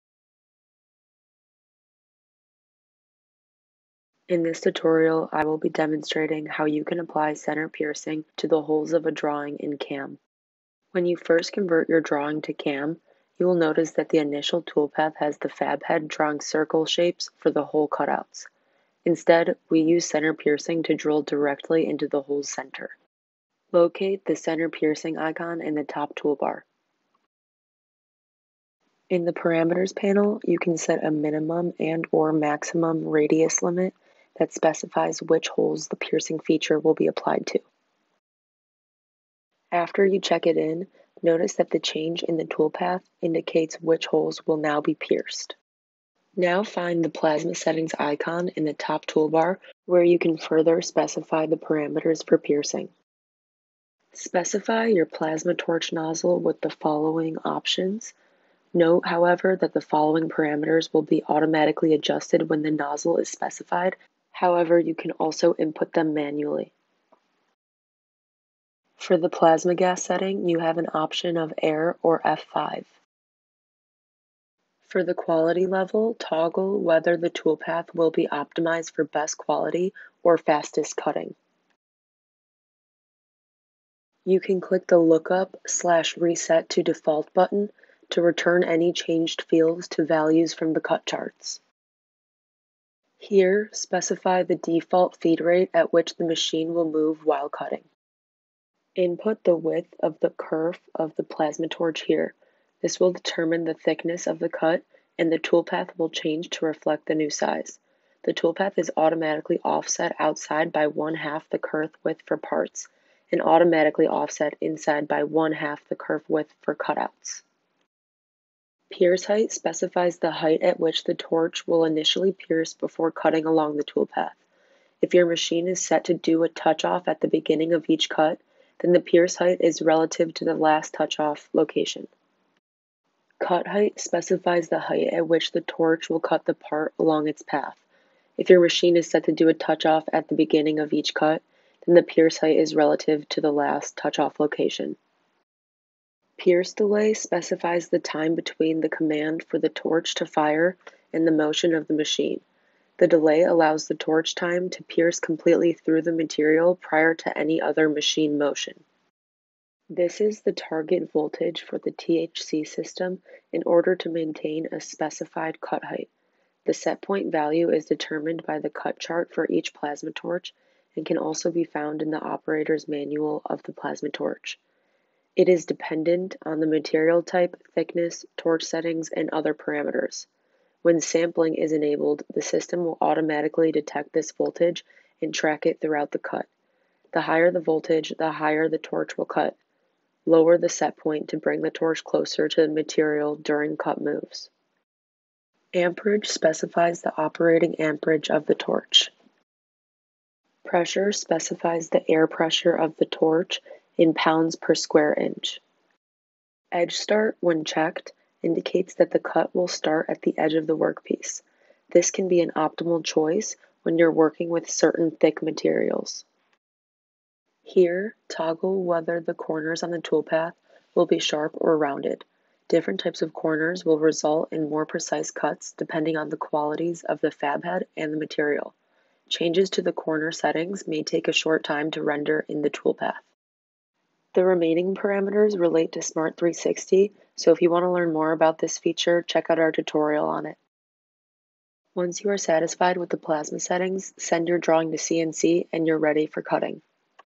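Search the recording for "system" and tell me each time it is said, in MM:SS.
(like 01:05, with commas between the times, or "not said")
02:42, 03:02.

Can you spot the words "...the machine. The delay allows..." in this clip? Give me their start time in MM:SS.
02:31.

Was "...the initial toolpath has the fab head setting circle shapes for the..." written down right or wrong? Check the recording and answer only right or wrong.
wrong.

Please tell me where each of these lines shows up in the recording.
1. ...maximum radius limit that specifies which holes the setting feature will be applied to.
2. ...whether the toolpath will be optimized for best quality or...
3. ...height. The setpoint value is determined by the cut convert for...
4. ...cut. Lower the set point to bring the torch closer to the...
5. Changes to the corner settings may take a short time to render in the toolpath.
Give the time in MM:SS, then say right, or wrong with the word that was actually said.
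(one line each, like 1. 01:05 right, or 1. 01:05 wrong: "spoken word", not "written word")
1. 00:32 wrong: "piercing", not "setting"
2. 01:16 right
3. 02:45 wrong: "chart", not "convert"
4. 03:09 right
5. 03:49 right.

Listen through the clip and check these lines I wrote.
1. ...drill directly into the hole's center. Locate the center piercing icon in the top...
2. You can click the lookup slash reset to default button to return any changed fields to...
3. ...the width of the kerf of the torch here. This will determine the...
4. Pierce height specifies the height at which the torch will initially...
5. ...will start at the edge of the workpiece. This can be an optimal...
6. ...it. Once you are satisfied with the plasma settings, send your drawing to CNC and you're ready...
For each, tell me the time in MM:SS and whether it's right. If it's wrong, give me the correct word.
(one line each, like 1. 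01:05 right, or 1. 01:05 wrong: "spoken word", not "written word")
1. 00:20 right
2. 01:24 right
3. 01:39 wrong: "plasmatorch", not "torch"
4. 01:58 right
5. 03:29 right
6. 04:00 right.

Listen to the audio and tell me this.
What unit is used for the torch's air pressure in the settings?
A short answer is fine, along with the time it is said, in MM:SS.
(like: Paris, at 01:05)
pounds per square inch, at 03:24.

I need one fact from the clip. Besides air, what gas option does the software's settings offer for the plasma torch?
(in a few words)
F5.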